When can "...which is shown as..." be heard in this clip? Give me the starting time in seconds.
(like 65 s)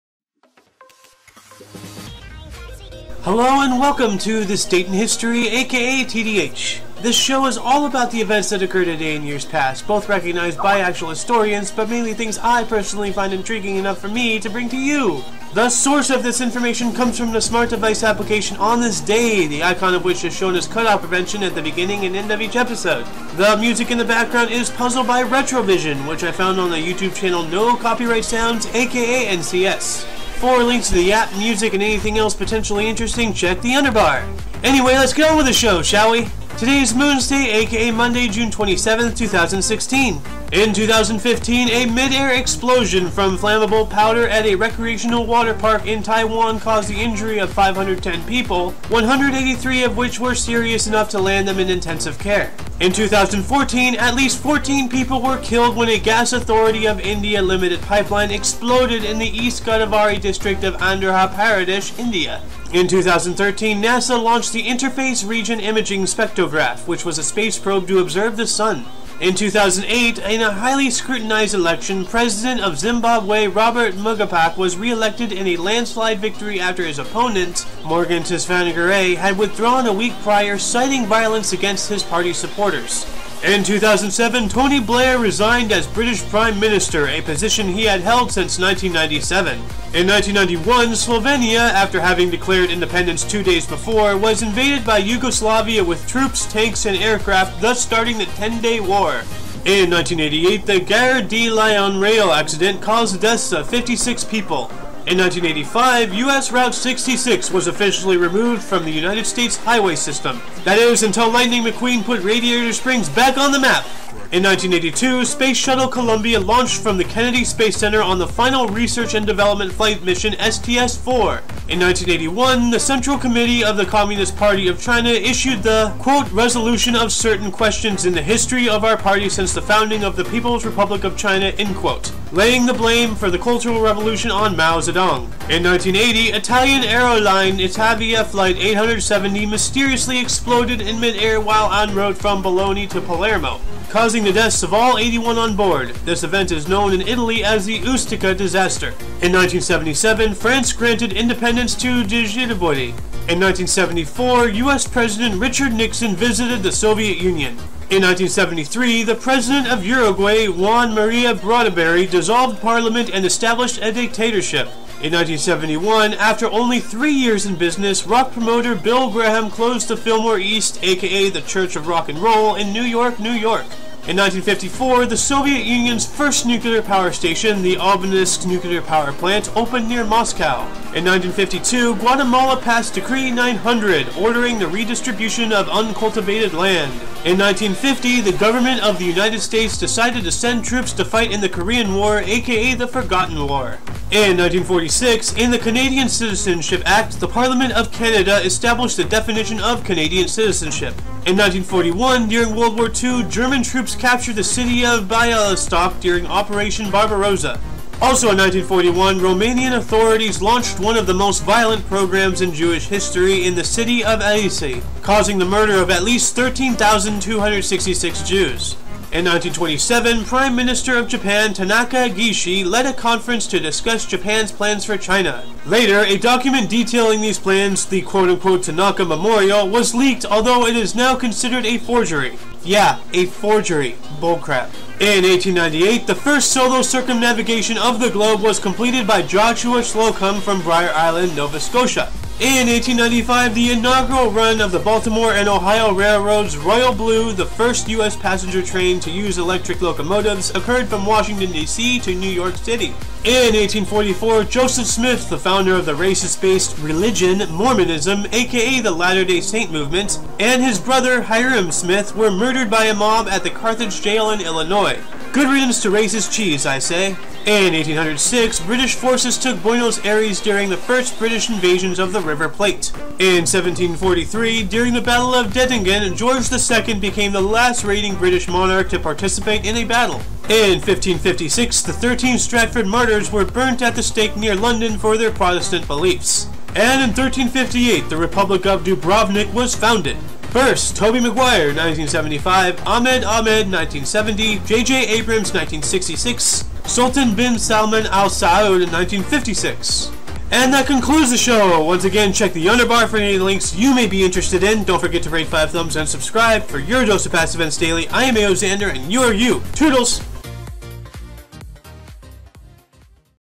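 20 s.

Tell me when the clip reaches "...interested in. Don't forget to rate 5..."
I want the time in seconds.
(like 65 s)
304 s.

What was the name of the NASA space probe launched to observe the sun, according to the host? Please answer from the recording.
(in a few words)
Interface Region Imaging Spectrograph.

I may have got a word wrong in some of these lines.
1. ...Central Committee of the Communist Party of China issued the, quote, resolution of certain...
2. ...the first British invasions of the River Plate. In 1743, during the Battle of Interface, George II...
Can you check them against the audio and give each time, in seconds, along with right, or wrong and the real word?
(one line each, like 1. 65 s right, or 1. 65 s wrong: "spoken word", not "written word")
1. 122 s right
2. 270 s wrong: "Dettingen", not "Interface".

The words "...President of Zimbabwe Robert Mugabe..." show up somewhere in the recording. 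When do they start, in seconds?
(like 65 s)
72 s.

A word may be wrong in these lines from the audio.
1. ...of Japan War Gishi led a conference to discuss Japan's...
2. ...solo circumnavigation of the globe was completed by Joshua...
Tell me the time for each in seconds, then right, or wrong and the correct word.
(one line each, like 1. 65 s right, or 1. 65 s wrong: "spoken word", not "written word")
1. 220 s wrong: "Tanaka", not "War"
2. 236 s right.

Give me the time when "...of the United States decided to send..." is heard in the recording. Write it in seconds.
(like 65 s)
188 s.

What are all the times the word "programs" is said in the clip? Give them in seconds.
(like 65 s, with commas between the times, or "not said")
211 s.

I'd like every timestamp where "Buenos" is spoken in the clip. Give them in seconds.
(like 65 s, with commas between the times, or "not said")
269 s.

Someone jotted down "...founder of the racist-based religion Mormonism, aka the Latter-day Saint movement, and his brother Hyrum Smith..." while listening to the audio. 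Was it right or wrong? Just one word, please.
right.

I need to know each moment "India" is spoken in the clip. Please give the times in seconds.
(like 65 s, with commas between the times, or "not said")
56 s, 61 s.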